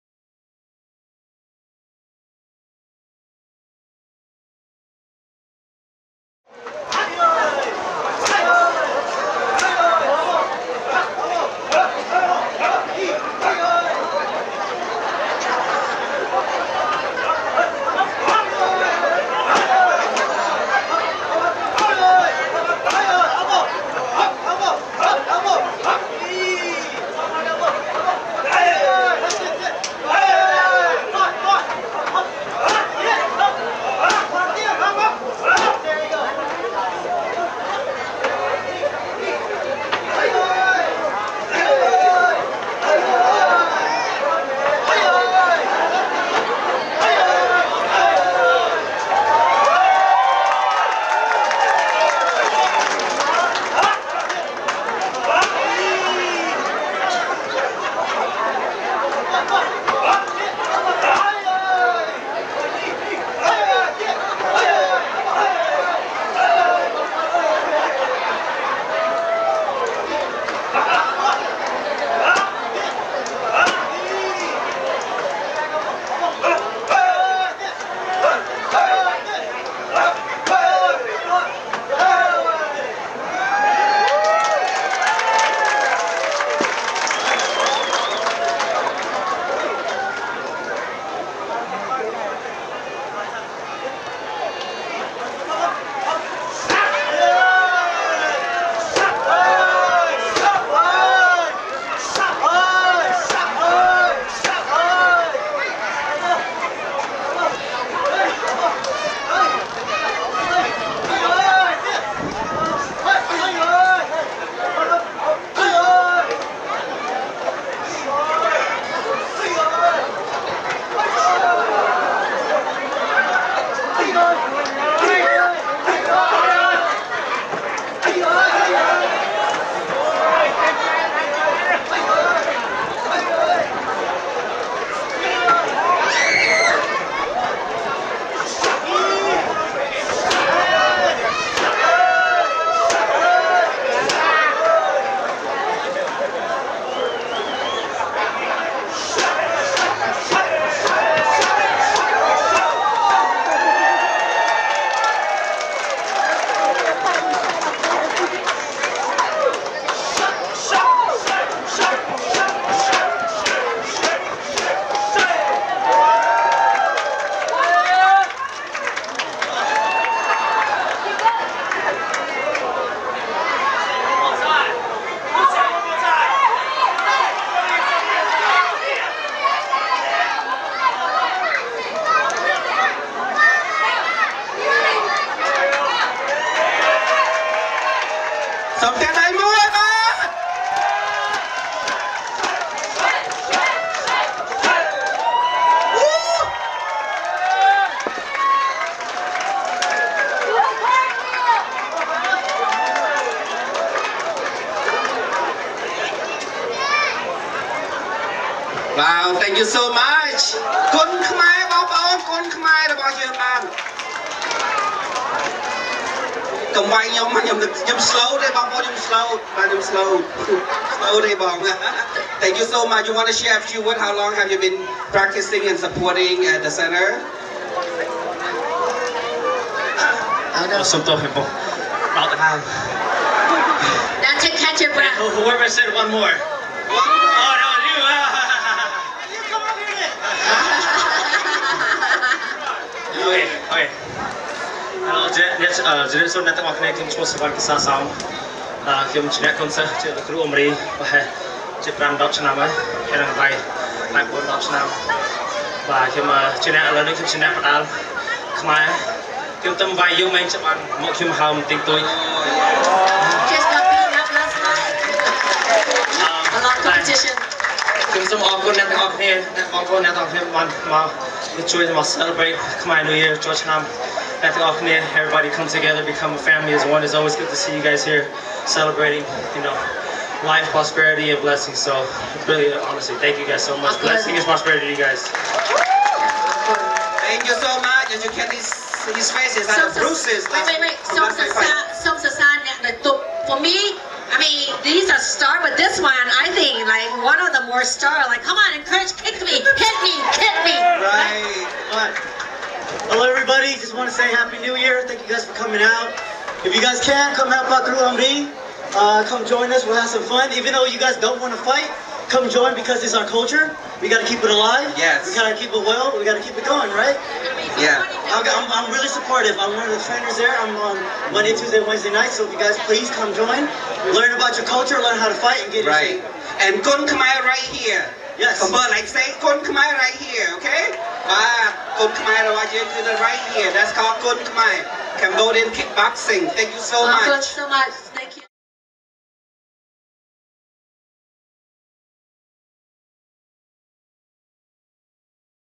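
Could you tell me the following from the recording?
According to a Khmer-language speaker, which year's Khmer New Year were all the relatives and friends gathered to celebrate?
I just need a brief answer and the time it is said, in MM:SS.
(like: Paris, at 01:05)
2023, at 04:33.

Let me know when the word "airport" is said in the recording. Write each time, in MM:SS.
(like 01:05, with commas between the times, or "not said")
not said.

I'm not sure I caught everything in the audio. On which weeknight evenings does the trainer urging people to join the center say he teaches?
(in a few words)
Monday, Tuesday, Wednesday.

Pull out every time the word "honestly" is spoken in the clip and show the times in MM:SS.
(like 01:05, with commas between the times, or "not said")
04:42.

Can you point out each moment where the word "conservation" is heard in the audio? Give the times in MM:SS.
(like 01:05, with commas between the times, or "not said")
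not said.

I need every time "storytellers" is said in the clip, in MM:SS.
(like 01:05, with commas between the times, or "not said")
not said.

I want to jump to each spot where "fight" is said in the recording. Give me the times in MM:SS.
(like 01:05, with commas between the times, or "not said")
05:11, 05:25.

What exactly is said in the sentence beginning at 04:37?
It's always good to see you guys here celebrating, you know, life, prosperity, and blessings.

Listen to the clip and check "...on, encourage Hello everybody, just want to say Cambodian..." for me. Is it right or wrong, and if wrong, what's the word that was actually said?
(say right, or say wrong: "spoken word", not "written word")
wrong: "Happy", not "Cambodian".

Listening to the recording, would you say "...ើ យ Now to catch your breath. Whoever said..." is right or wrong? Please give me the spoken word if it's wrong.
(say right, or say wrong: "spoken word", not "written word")
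right.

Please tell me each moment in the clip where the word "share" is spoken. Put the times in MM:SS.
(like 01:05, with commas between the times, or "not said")
03:43.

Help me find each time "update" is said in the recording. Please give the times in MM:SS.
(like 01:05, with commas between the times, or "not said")
not said.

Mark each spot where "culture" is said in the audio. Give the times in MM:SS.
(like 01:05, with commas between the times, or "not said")
05:13, 05:24.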